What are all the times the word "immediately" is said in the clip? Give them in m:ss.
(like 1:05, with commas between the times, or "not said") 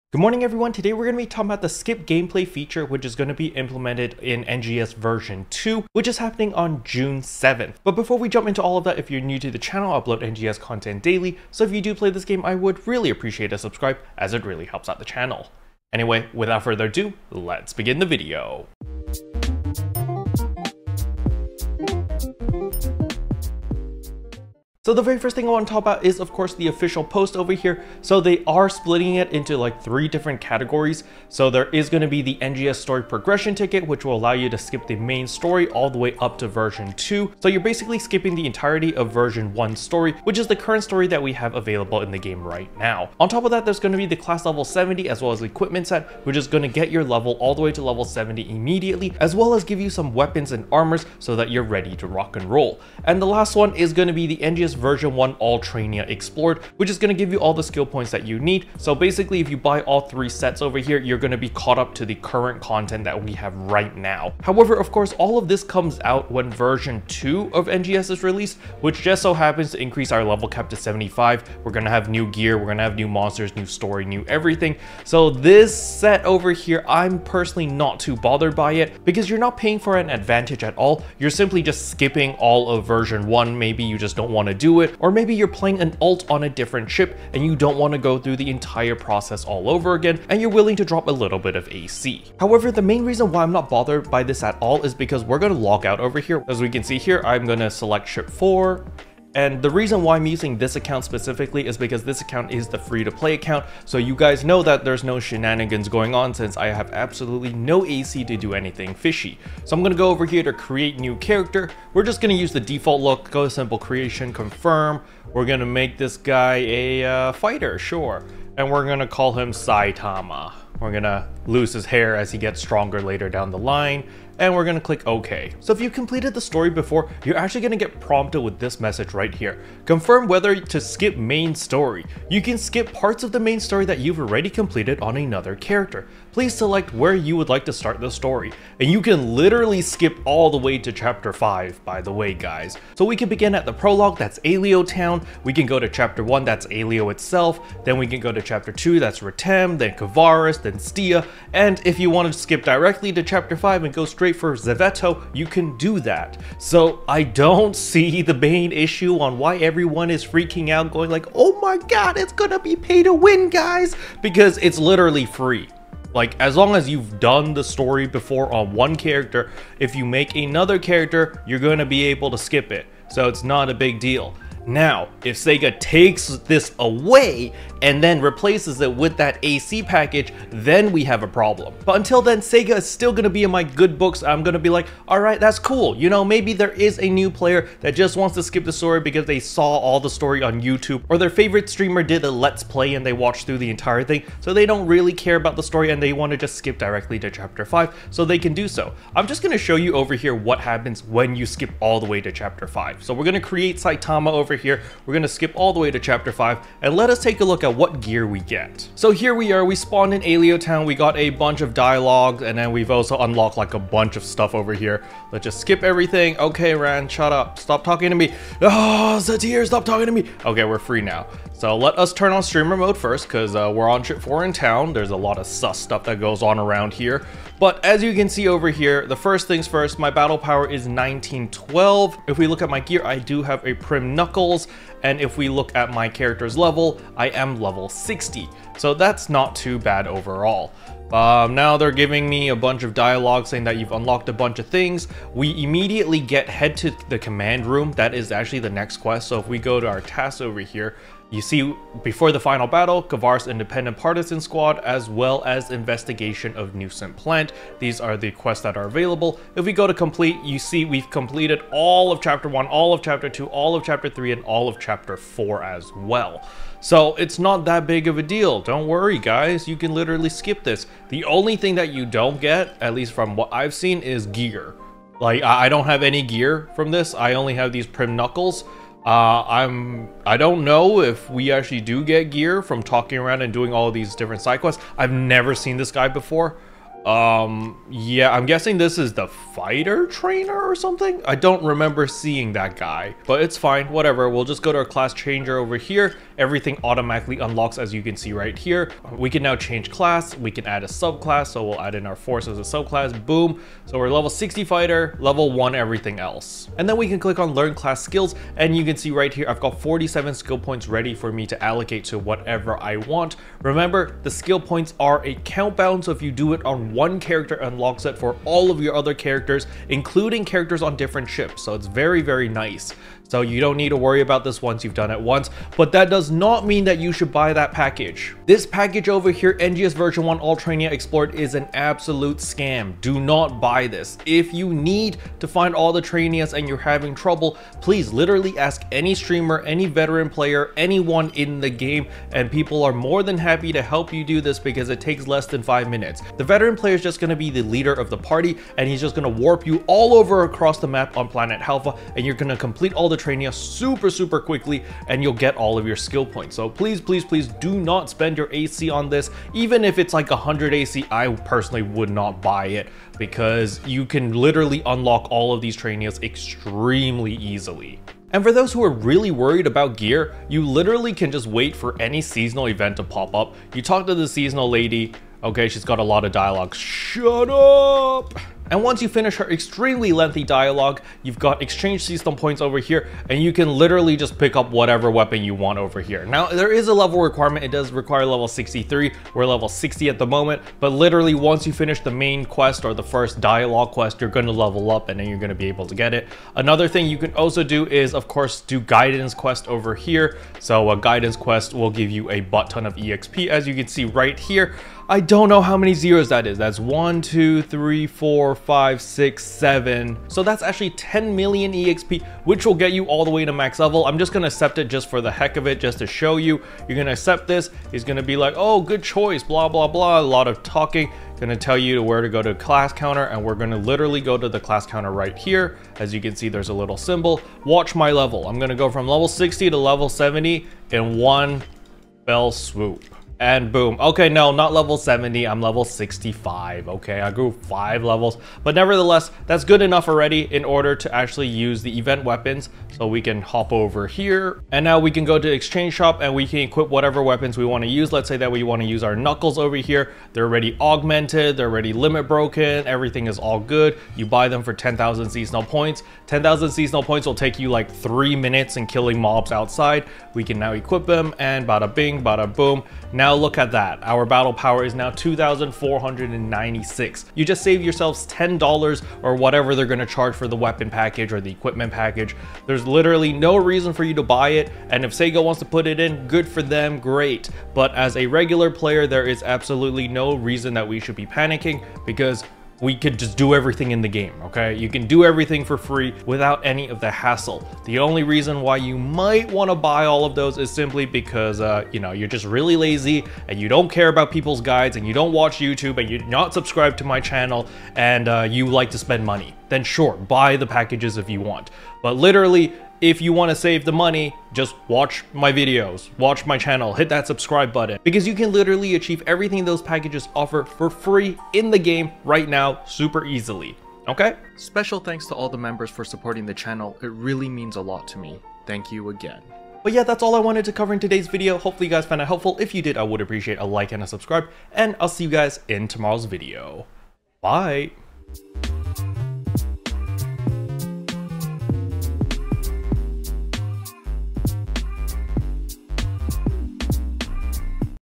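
0:48, 4:05.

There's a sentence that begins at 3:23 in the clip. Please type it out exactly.
So we're gonna create Saitama over here.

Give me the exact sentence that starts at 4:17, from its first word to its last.
These are the quests that are available.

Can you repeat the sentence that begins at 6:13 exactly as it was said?
You talk to the seasonal lady, okay, she's got a lot of dialogue, shut up!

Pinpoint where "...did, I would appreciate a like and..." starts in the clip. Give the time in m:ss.
8:42.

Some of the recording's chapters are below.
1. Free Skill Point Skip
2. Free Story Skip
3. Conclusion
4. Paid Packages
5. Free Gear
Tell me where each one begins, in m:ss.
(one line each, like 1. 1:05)
1. 4:53
2. 1:33
3. 8:40
4. 0:25
5. 6:09.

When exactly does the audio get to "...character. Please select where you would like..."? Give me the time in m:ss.
2:15.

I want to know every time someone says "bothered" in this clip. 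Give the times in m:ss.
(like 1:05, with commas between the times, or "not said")
1:18, 1:33.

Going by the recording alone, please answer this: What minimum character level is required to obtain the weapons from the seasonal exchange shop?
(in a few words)
63.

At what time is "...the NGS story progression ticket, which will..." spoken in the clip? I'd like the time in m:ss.
0:32.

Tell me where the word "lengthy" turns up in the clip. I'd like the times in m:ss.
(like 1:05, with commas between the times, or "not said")
6:20.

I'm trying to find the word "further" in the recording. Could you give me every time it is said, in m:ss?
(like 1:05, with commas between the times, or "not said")
0:16.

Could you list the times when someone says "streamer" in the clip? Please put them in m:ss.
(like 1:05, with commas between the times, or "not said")
3:11, 3:42, 5:39.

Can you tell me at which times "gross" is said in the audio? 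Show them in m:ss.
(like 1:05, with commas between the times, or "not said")
not said.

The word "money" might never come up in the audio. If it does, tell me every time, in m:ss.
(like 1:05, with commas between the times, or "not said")
8:19, 8:23.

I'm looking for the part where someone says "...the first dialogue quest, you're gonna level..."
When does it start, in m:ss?
6:32.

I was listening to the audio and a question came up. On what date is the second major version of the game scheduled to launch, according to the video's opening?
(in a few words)
June 7th.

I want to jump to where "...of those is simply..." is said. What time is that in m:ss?
8:10.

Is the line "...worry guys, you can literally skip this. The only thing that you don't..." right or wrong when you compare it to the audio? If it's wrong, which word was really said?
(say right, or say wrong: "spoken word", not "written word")
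right.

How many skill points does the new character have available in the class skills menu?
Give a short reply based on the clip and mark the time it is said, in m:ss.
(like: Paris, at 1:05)
47, at 5:09.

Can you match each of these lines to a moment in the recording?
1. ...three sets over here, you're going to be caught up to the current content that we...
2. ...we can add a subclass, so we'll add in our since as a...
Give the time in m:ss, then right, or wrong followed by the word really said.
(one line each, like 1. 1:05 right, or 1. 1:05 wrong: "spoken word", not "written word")
1. 1:00 right
2. 5:00 wrong: "force", not "since".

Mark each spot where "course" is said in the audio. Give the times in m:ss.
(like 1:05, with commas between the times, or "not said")
0:26, 1:04, 6:38.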